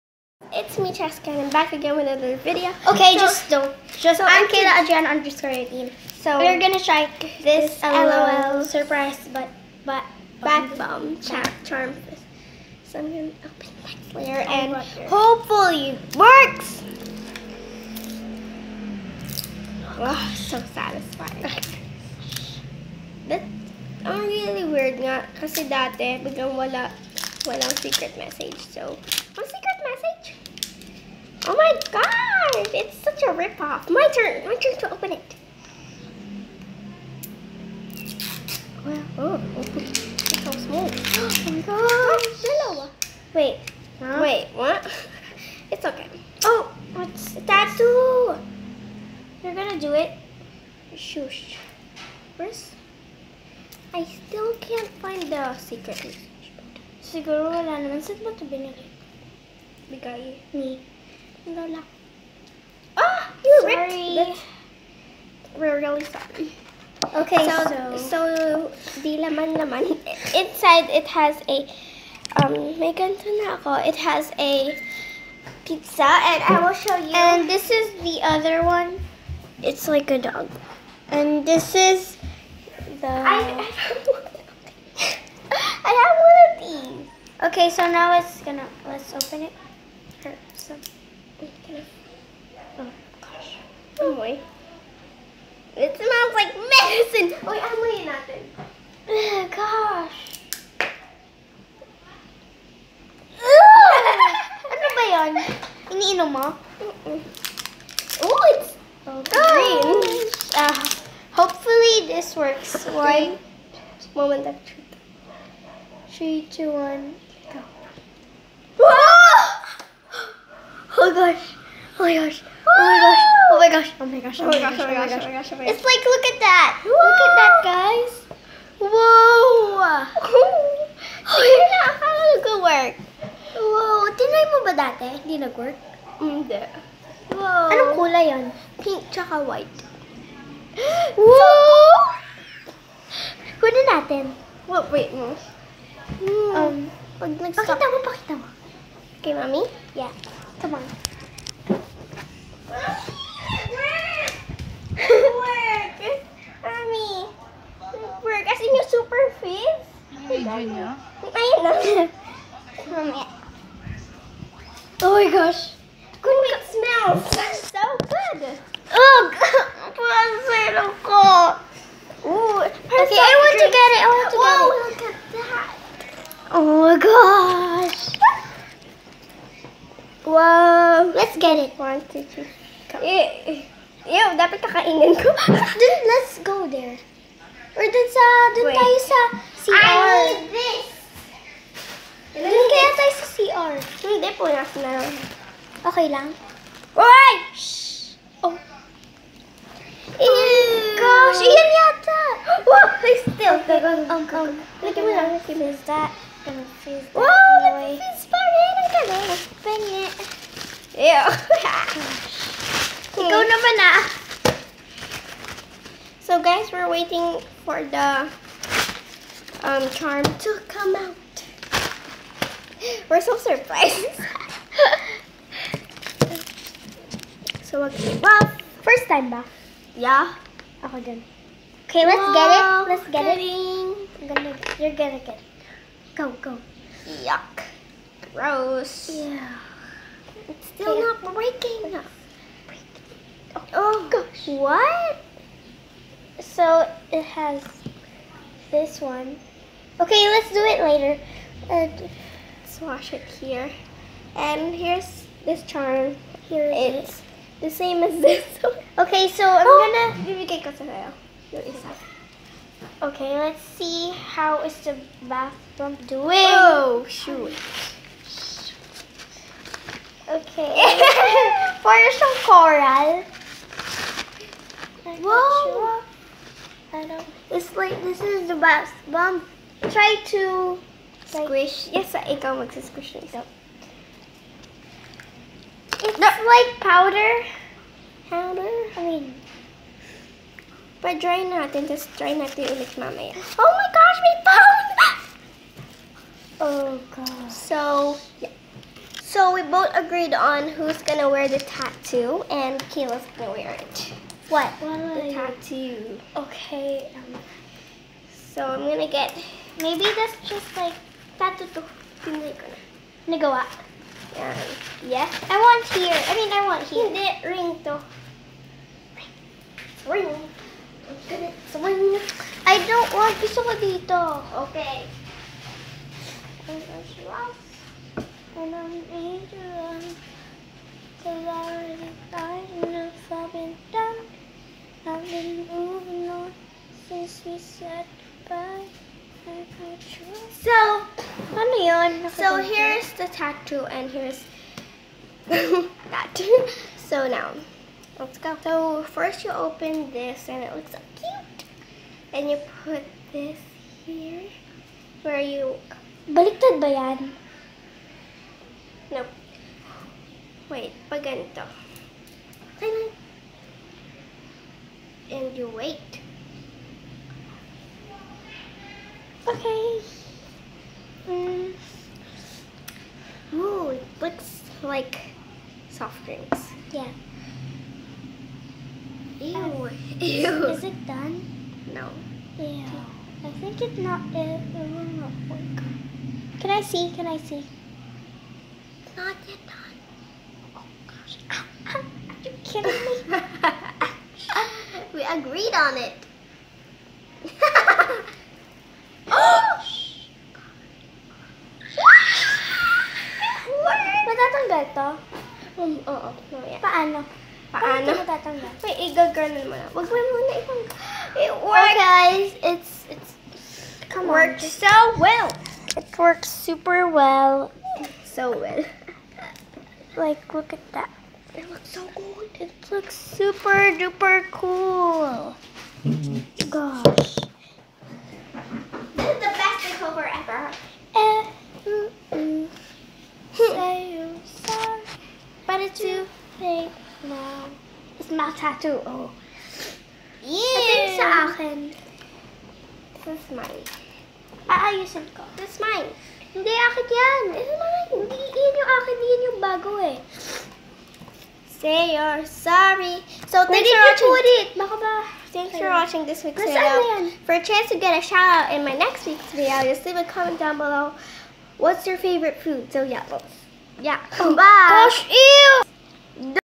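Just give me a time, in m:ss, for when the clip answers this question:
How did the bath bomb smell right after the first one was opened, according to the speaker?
1:36.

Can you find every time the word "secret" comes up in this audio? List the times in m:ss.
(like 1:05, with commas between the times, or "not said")
0:27, 0:55.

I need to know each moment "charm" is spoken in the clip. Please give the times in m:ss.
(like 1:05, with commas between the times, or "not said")
0:11, 3:39, 4:15.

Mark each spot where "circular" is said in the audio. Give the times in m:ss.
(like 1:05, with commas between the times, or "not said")
not said.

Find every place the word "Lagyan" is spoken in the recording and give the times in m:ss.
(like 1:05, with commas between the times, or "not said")
3:24.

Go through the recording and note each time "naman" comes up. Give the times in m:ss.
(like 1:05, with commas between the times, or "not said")
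0:57, 3:33.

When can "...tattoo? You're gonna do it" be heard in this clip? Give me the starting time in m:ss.
0:47.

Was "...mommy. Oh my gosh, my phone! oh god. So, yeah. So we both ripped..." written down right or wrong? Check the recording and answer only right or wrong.
wrong.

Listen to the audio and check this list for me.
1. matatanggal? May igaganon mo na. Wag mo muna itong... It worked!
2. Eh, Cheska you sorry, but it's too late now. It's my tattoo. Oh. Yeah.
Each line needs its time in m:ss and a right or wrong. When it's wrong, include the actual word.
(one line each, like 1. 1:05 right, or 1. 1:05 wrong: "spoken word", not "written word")
1. 6:48 right
2. 7:11 wrong: "Say", not "Cheska".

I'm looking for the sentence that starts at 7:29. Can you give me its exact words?
Yun yung bago eh say you're sorry.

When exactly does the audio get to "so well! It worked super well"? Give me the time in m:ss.
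6:54.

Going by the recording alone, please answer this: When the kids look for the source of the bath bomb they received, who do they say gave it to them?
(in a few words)
Lola.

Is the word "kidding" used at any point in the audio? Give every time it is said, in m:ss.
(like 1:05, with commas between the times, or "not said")
3:53, 6:32.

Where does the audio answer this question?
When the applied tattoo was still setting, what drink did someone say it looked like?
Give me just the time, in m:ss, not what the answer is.
6:15.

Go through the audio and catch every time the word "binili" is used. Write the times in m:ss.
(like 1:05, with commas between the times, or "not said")
0:58.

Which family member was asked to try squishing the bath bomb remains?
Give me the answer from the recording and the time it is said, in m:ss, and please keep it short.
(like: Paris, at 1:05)
Mom, at 4:39.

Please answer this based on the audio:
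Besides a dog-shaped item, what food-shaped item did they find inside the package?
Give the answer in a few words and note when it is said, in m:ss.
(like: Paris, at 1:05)
Pizza, at 1:15.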